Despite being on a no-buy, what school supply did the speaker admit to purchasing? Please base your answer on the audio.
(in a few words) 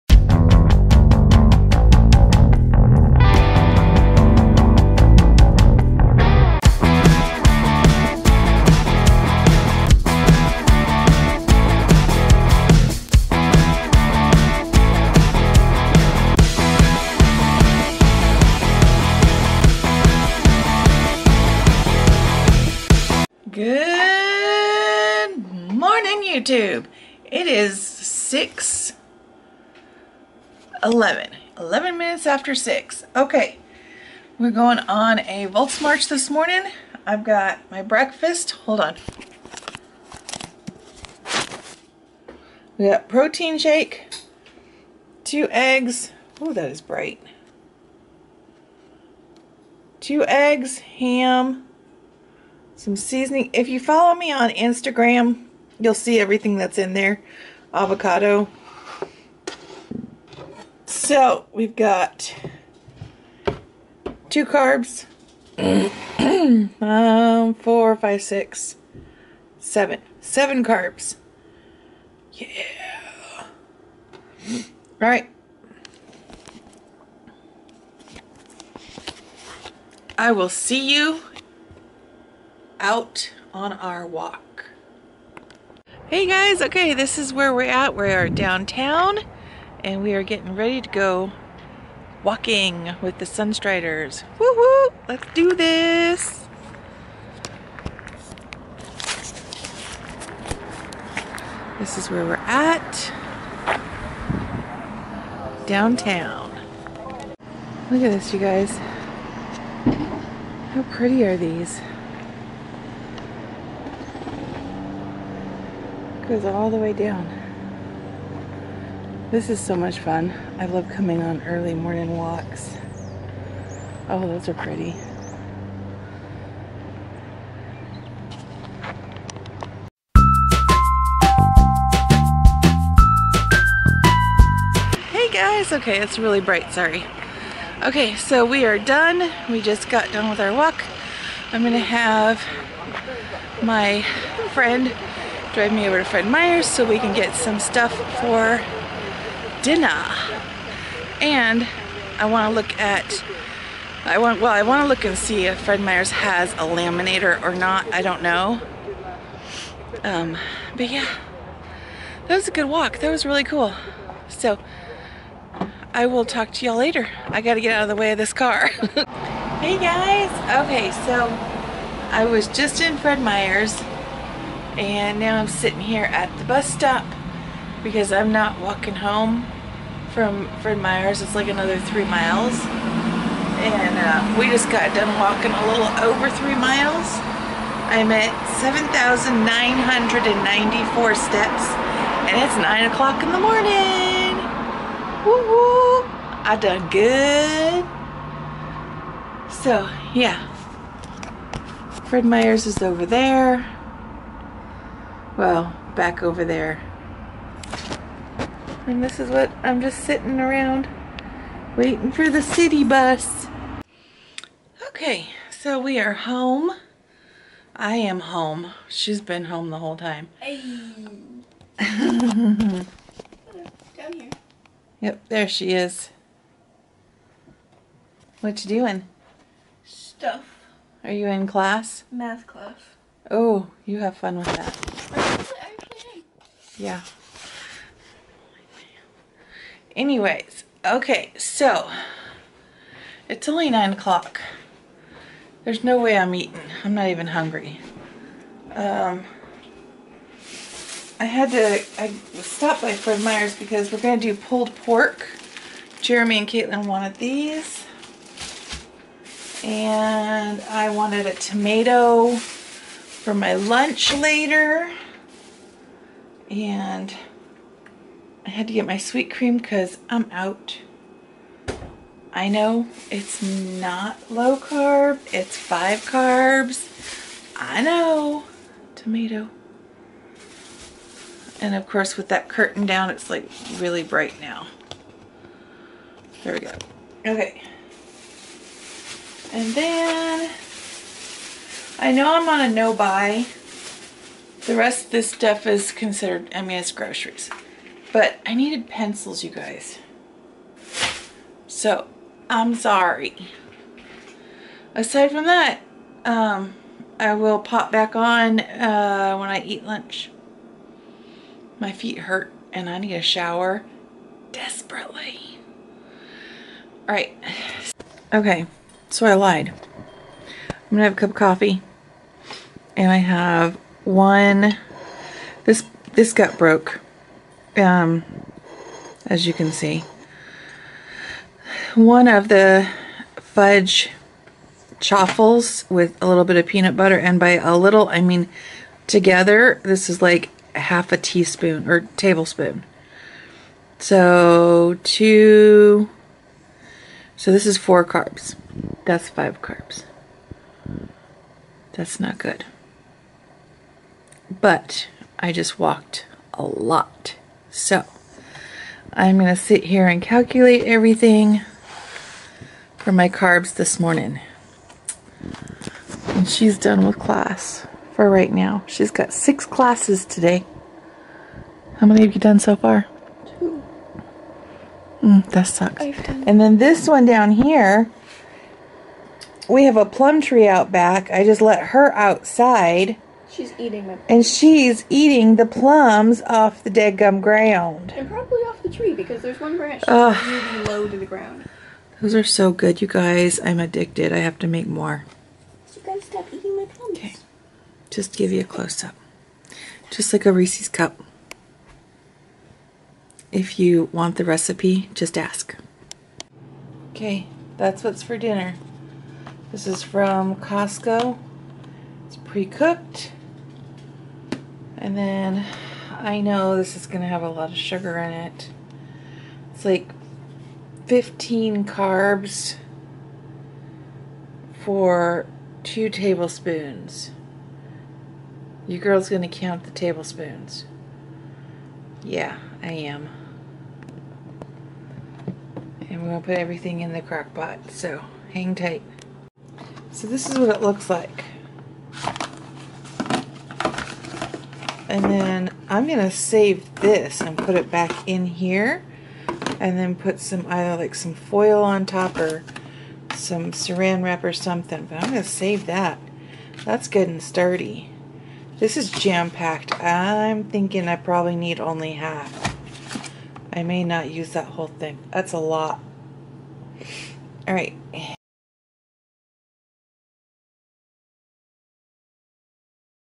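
pencils.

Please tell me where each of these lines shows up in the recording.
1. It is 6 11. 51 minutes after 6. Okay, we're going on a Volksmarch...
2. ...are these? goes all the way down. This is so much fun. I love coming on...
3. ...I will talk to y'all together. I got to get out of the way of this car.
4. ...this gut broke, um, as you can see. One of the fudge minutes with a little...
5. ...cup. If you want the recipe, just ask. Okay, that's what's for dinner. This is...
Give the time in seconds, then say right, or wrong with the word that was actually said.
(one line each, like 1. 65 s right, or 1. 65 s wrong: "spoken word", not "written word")
1. 27 s wrong: "11", not "51"
2. 111 s right
3. 165 s wrong: "later", not "together"
4. 326 s wrong: "chaffles", not "minutes"
5. 400 s right.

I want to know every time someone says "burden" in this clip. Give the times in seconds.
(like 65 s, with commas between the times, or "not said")
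not said.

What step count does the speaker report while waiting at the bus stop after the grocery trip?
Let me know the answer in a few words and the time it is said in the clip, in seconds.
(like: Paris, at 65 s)
7,994, at 188 s.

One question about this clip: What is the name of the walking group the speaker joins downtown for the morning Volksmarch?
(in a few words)
Sunstriders.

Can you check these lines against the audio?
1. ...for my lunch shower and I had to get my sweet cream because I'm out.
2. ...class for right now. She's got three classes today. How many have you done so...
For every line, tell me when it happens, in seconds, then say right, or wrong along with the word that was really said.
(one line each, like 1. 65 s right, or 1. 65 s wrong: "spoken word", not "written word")
1. 262 s wrong: "later", not "shower"
2. 367 s wrong: "six", not "three".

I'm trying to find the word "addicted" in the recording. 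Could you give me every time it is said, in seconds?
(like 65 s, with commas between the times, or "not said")
393 s.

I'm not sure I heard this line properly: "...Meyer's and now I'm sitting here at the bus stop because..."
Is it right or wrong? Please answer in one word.
right.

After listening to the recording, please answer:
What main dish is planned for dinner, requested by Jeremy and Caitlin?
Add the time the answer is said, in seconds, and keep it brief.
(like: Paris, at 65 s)
pulled pork, at 254 s.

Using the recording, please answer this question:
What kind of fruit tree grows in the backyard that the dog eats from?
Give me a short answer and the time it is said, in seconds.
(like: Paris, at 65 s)
plum tree, at 380 s.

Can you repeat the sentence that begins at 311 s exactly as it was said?
My feet hurt and I need a shower desperately.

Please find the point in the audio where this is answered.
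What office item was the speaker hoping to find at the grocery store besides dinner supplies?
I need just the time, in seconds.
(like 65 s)
156 s.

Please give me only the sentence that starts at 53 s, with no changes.
If you follow me on Instagram, You'll see everything that's in there.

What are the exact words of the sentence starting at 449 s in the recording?
And then put some, either like some foil on top or some saran wrap or something.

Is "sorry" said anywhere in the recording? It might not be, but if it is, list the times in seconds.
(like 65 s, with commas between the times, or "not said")
136 s, 302 s.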